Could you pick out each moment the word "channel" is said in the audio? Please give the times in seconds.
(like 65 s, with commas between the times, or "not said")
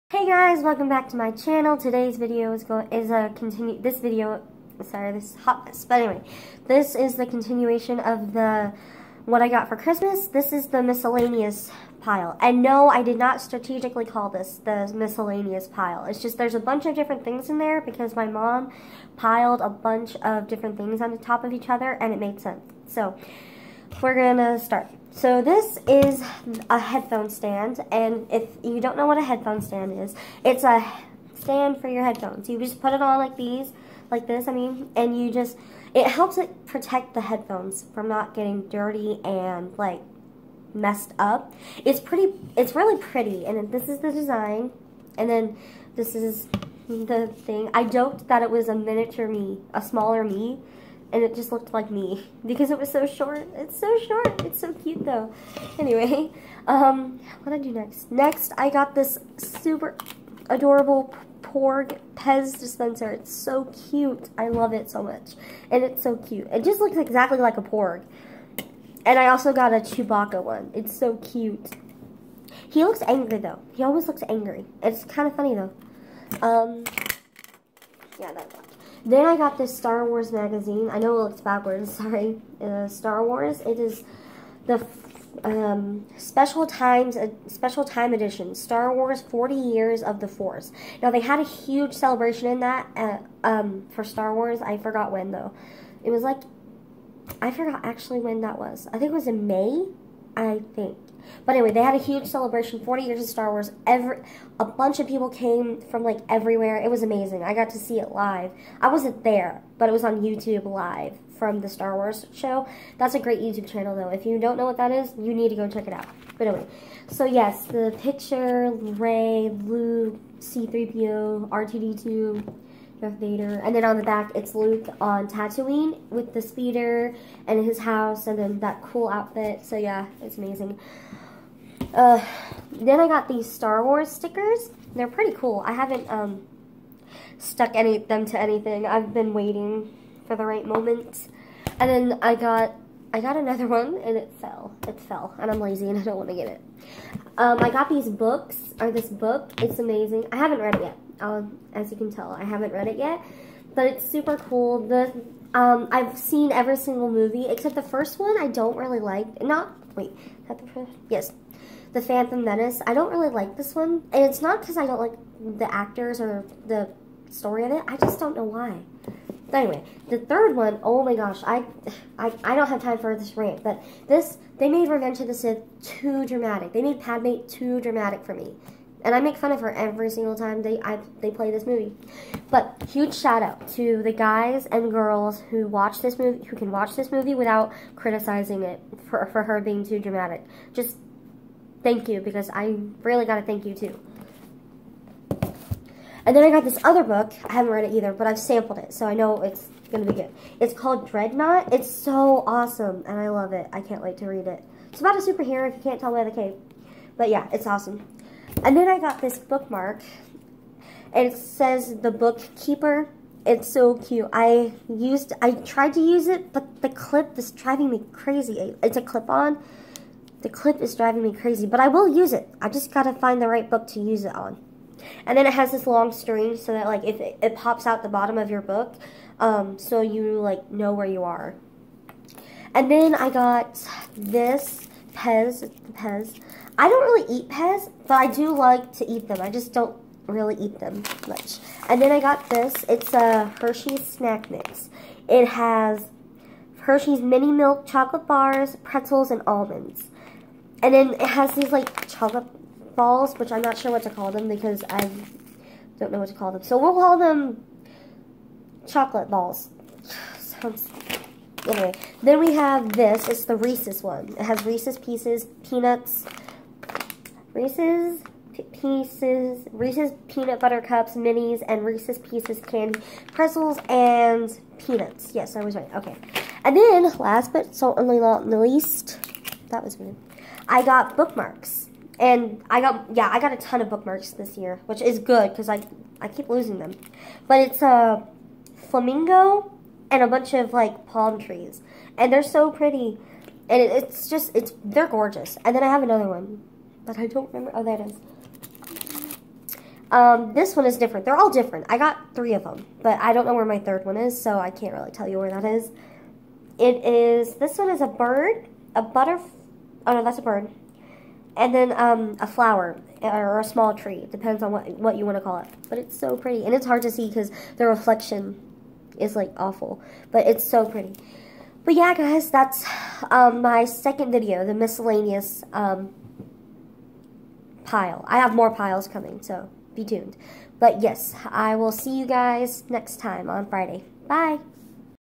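1 s, 113 s.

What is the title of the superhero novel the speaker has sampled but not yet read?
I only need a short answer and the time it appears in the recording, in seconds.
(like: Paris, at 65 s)
Dreadnought, at 201 s.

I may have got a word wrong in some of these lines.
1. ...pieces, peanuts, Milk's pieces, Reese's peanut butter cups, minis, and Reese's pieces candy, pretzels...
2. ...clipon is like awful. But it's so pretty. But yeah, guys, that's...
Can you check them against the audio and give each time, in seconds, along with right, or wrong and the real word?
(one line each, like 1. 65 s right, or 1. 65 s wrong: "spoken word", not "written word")
1. 264 s wrong: "Reese", not "Milk"
2. 317 s wrong: "reflection", not "clipon".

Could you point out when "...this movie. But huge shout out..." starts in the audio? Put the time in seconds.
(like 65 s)
181 s.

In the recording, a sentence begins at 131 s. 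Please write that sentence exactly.
Uh, then I got these Star Wars stickers.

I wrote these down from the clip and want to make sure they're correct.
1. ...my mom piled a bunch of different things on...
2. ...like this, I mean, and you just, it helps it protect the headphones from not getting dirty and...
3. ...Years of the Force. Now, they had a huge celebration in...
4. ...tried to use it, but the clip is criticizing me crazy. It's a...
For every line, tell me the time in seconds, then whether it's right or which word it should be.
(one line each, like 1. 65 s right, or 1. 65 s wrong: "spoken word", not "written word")
1. 18 s right
2. 34 s right
3. 89 s right
4. 215 s wrong: "driving", not "criticizing".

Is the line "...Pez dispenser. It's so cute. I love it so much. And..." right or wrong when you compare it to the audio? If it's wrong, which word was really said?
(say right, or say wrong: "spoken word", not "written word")
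right.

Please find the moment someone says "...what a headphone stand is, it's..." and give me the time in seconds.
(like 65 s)
29 s.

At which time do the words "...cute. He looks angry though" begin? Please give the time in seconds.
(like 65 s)
71 s.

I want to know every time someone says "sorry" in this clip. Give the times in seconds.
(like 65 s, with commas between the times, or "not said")
4 s, 81 s.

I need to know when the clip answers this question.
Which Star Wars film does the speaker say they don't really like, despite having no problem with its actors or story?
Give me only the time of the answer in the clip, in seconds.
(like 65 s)
161 s.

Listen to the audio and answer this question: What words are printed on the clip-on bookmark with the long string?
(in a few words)
The Bookkeeper.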